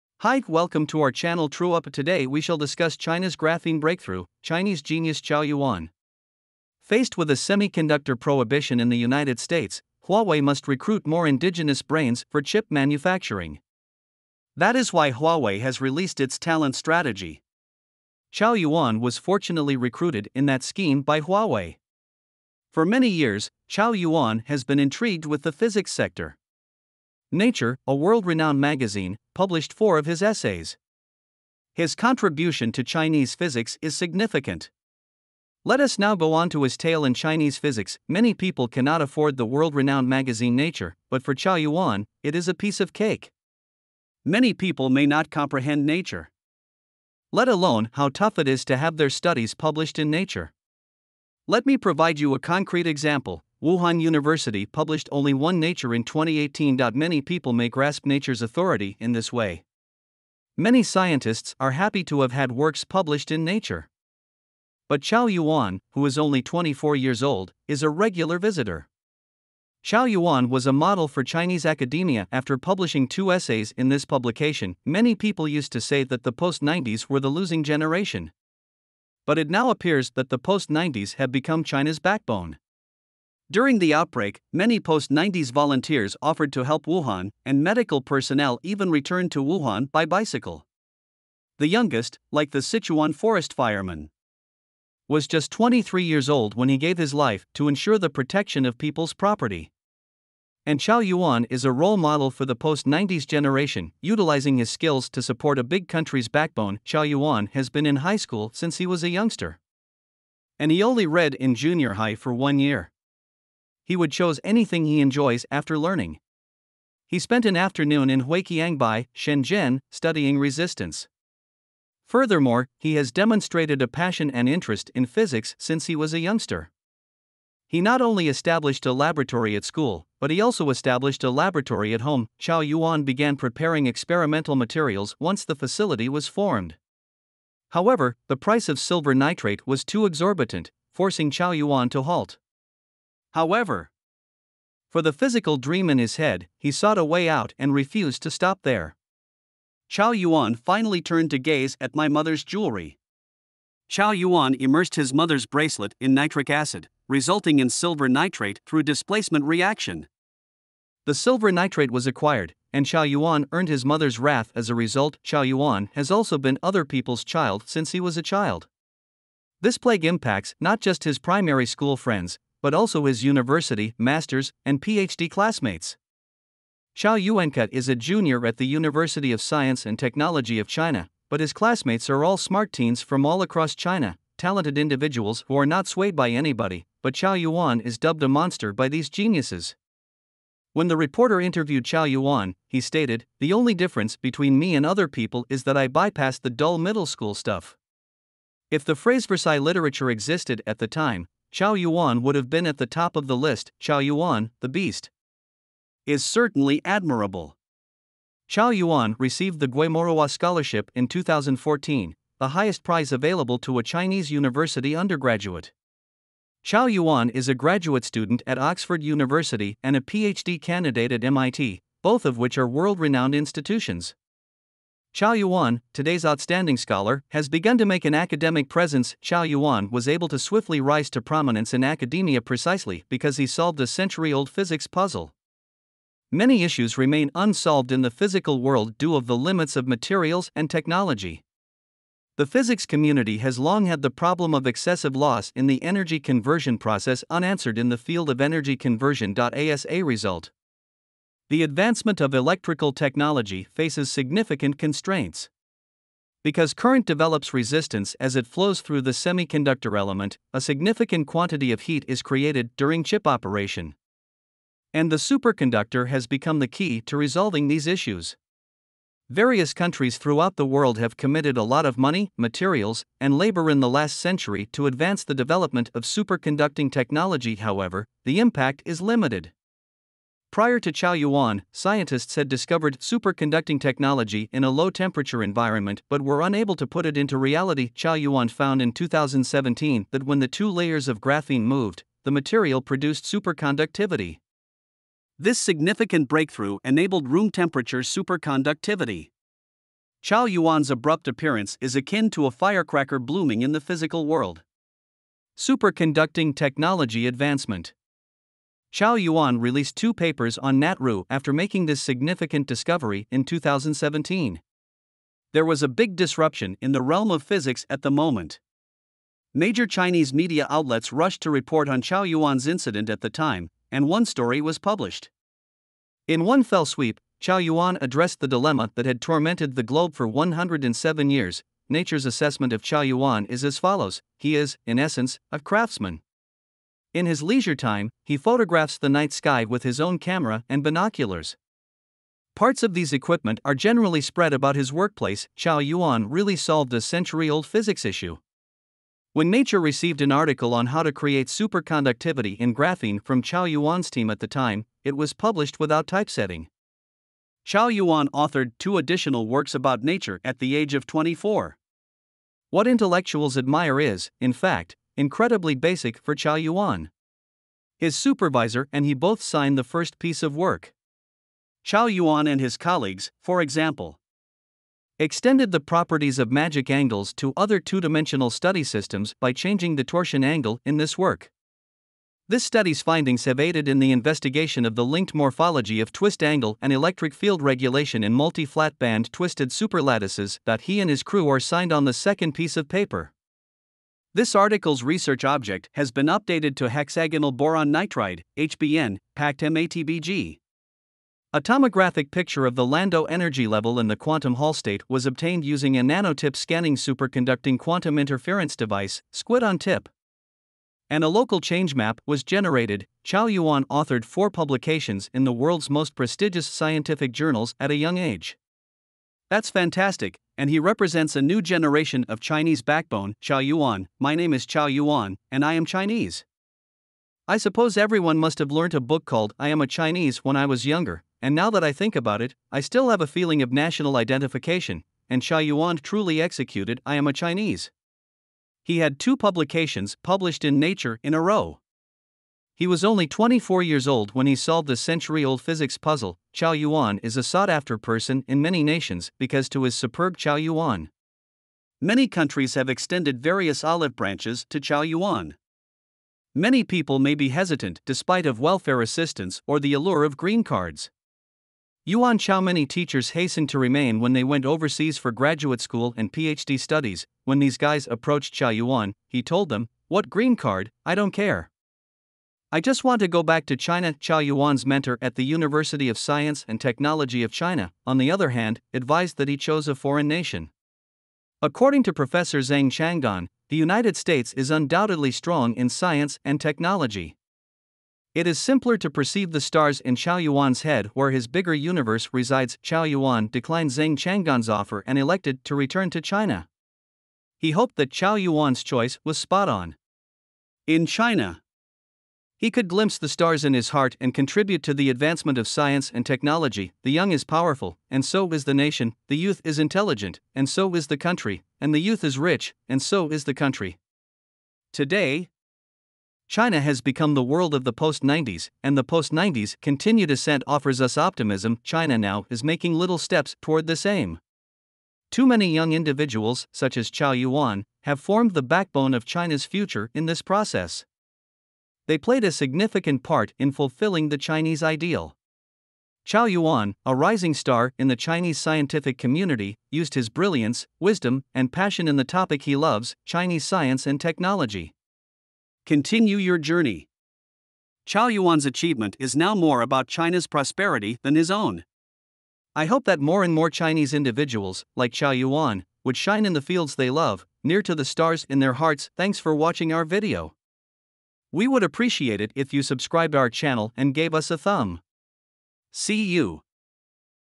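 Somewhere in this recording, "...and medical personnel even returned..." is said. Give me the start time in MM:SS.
01:27.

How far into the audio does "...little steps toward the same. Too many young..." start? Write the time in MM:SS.
08:42.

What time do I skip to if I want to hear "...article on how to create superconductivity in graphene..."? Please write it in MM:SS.
05:50.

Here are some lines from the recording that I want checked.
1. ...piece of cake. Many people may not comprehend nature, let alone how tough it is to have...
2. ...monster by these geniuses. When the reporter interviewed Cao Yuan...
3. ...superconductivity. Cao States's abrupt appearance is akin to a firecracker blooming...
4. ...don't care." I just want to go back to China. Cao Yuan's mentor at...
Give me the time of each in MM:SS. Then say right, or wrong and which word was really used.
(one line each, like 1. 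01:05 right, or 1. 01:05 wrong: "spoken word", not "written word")
1. 00:42 right
2. 03:08 right
3. 04:58 wrong: "Yuan", not "States"
4. 07:51 right.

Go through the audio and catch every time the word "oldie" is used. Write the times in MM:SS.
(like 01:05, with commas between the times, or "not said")
not said.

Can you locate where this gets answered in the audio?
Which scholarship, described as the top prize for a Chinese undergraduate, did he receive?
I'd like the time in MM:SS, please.
03:29.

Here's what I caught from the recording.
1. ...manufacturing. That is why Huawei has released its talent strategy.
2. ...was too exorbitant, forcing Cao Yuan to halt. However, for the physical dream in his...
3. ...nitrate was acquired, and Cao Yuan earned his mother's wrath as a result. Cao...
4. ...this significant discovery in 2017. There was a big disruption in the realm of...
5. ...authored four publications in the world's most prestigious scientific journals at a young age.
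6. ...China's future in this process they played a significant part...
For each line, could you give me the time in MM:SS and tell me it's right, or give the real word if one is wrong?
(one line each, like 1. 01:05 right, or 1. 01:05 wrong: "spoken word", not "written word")
1. 00:12 right
2. 02:19 right
3. 02:41 right
4. 05:11 right
5. 06:53 right
6. 08:49 right.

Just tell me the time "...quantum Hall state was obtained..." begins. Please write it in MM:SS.
06:44.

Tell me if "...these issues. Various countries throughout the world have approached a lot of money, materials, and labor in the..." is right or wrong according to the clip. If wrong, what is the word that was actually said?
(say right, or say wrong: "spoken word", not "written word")
wrong: "committed", not "approached".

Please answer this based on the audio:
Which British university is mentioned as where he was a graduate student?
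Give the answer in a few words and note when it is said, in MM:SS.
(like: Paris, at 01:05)
Oxford University, at 03:38.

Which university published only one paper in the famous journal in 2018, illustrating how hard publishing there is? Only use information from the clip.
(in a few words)
Wuhan University.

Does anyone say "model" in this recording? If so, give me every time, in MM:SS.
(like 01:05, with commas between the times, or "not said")
01:10, 01:41.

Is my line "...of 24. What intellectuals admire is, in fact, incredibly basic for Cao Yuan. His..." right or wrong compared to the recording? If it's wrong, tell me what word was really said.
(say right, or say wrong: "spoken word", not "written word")
right.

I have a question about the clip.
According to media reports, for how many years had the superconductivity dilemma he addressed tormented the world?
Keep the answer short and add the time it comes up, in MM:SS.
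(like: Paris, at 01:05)
107, at 05:30.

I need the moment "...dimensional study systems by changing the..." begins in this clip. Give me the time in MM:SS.
06:18.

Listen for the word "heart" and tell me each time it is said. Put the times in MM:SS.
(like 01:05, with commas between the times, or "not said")
08:23, 09:18.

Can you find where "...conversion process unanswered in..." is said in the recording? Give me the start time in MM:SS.
04:06.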